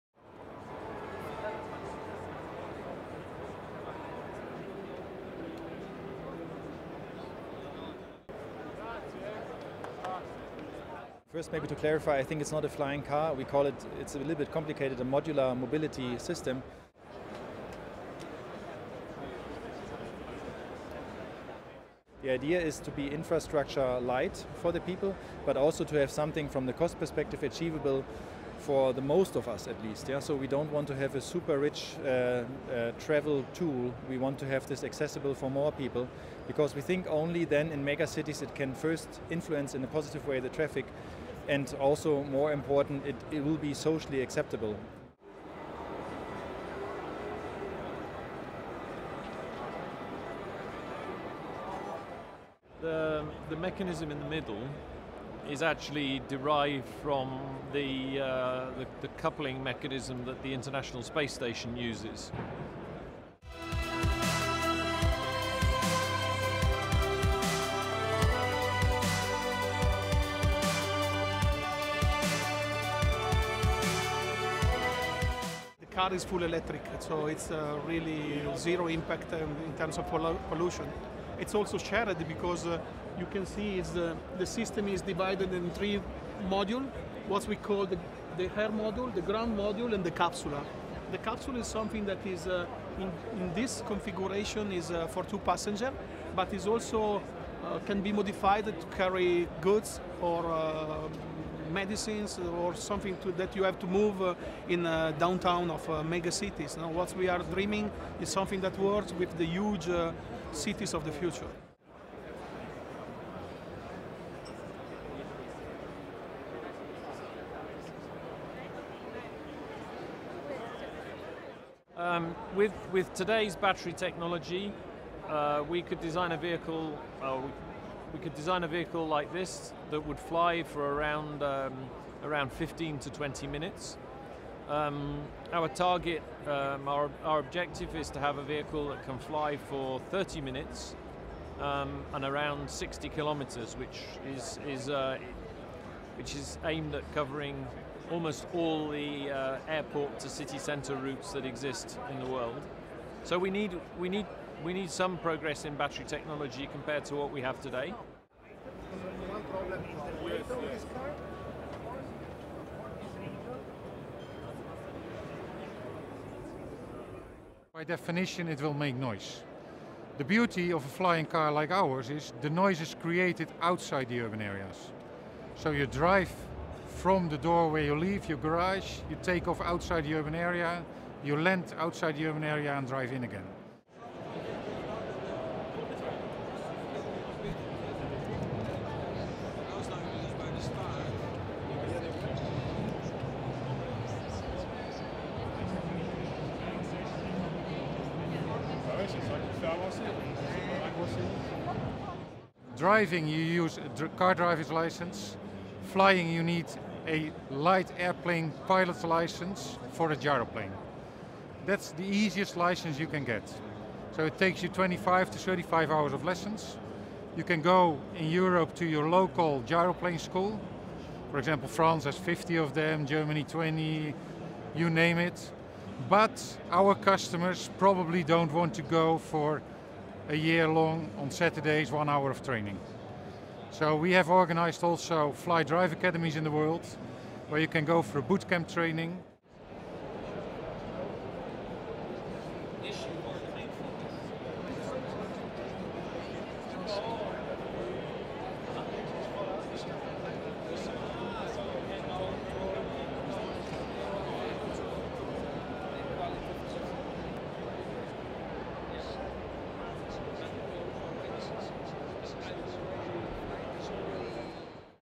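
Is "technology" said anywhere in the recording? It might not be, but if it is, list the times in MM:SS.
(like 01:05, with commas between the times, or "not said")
02:03, 02:36.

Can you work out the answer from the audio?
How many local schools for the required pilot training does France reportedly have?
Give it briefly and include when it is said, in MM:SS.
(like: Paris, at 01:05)
50, at 03:42.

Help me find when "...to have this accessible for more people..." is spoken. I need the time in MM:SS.
00:34.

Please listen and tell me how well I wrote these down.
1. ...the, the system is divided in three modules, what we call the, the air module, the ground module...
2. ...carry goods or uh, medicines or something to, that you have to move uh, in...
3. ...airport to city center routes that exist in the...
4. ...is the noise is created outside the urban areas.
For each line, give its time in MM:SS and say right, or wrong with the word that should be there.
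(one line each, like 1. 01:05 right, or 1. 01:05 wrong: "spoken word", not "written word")
1. 01:23 right
2. 01:38 right
3. 02:29 right
4. 02:52 right.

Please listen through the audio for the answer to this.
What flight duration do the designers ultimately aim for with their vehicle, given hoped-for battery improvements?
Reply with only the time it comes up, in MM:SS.
02:20.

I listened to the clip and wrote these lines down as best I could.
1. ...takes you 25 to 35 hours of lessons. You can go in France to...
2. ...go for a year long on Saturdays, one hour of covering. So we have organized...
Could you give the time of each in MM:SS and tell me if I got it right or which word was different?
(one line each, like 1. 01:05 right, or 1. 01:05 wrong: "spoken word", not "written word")
1. 03:34 wrong: "Europe", not "France"
2. 03:48 wrong: "training", not "covering".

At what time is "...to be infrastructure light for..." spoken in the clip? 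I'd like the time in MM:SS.
00:22.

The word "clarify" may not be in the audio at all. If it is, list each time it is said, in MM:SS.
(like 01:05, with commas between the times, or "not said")
00:11.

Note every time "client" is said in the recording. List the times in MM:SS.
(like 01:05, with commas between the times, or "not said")
not said.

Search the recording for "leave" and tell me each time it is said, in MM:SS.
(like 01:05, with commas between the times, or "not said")
02:57.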